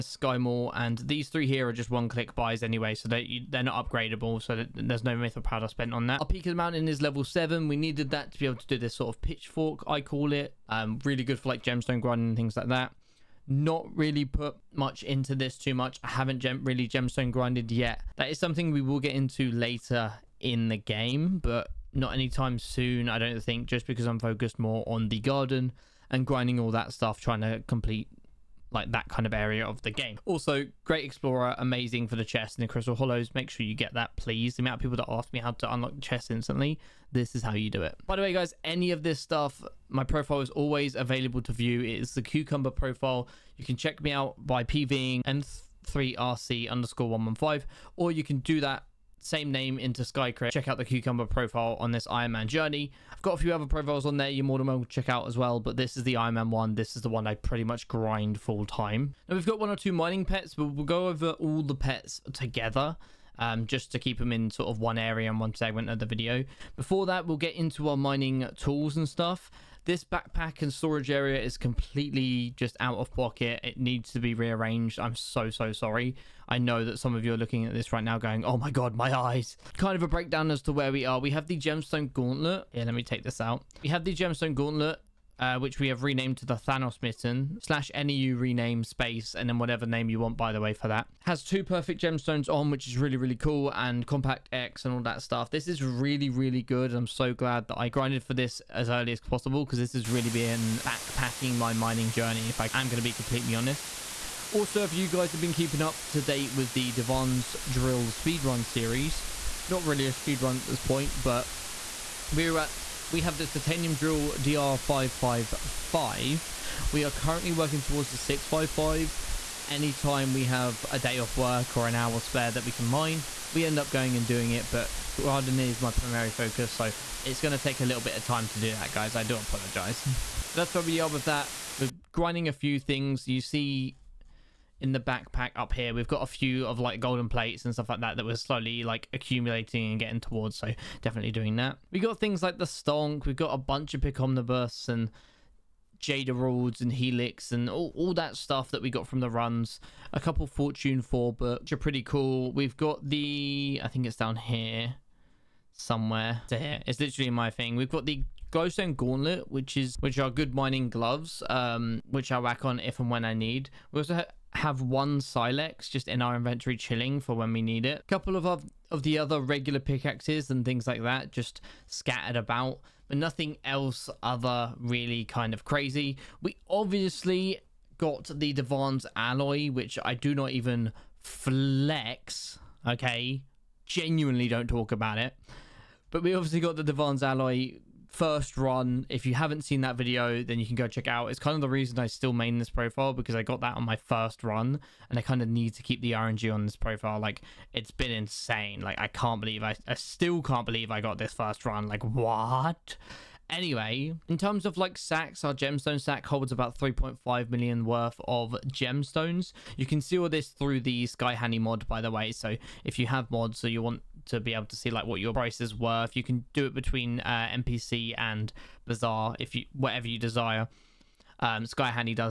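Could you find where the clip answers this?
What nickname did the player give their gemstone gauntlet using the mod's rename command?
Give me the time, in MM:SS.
01:26.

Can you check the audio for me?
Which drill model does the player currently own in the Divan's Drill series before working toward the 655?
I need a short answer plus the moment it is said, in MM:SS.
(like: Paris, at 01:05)
DR555, at 01:54.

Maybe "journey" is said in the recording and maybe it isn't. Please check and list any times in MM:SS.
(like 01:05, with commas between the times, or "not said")
00:52, 01:42.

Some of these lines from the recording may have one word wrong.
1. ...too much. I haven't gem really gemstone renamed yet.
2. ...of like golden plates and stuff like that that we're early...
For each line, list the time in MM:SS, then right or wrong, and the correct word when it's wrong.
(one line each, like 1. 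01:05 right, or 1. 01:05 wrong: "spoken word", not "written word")
1. 00:15 wrong: "grinded", not "renamed"
2. 02:16 wrong: "slowly", not "early".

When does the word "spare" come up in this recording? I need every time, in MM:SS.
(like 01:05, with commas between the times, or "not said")
02:02.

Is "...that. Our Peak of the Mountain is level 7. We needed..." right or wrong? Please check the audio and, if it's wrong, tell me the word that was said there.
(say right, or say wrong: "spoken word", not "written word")
right.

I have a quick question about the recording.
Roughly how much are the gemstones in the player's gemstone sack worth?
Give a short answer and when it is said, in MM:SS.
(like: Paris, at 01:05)
3.5 million, at 03:26.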